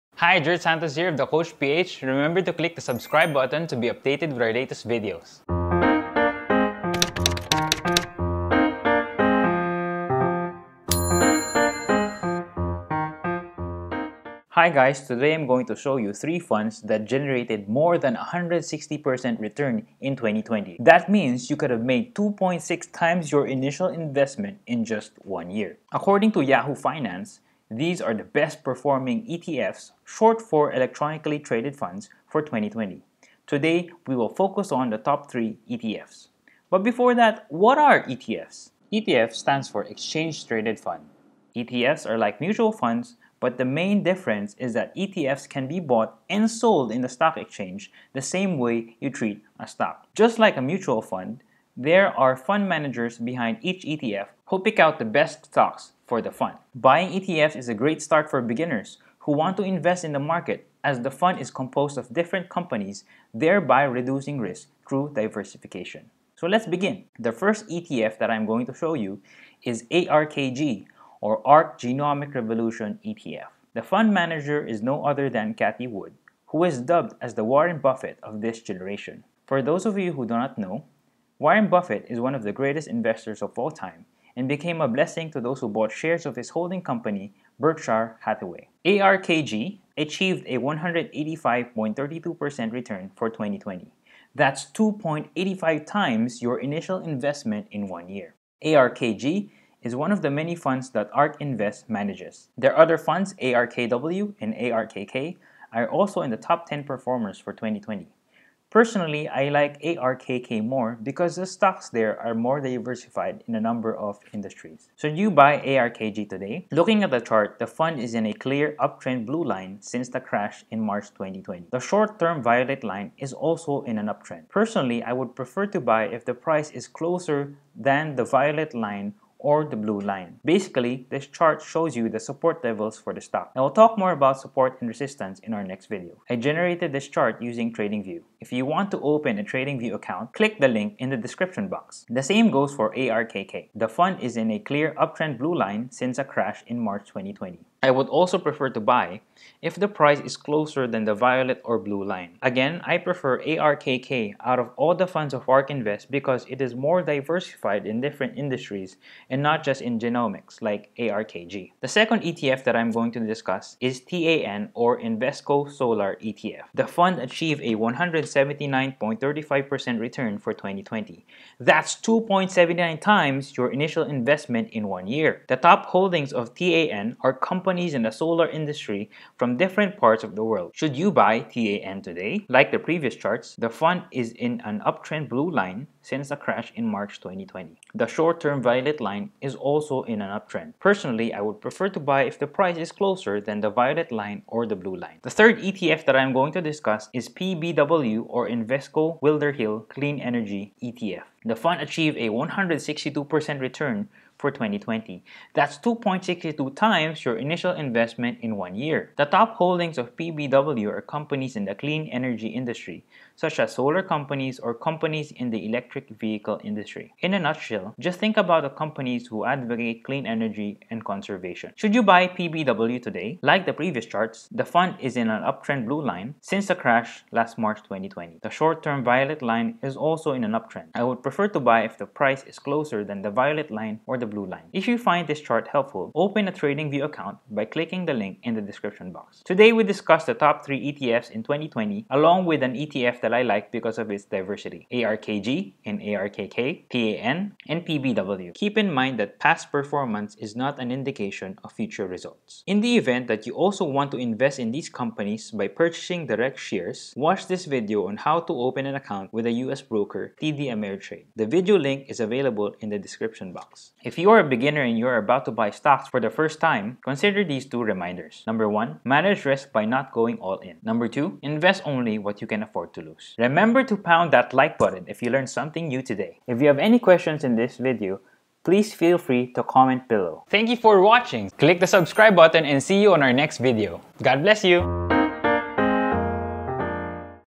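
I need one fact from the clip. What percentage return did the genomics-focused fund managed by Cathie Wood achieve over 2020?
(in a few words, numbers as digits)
185.32%.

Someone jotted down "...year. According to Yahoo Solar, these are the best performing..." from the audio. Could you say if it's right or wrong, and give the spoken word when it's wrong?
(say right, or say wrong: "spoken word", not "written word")
wrong: "Finance", not "Solar".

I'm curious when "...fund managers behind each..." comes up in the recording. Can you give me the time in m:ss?
0:52.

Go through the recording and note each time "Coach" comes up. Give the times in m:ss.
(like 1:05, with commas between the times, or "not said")
0:01.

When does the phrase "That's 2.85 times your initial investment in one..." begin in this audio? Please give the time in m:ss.
1:34.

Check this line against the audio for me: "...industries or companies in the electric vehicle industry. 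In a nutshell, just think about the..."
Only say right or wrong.
wrong.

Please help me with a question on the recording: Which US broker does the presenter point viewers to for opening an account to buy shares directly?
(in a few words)
TD Ameritrade.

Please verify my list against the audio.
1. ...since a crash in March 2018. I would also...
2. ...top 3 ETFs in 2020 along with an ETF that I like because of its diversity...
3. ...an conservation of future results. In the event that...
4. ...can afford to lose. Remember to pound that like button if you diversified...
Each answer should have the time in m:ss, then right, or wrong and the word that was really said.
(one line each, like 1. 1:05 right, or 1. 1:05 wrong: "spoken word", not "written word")
1. 2:25 wrong: "2020", not "2018"
2. 4:00 right
3. 4:10 wrong: "indication", not "conservation"
4. 4:32 wrong: "learned", not "diversified".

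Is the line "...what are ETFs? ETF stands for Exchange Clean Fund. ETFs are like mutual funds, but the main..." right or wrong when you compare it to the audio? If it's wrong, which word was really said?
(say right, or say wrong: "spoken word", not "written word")
wrong: "Traded", not "Clean".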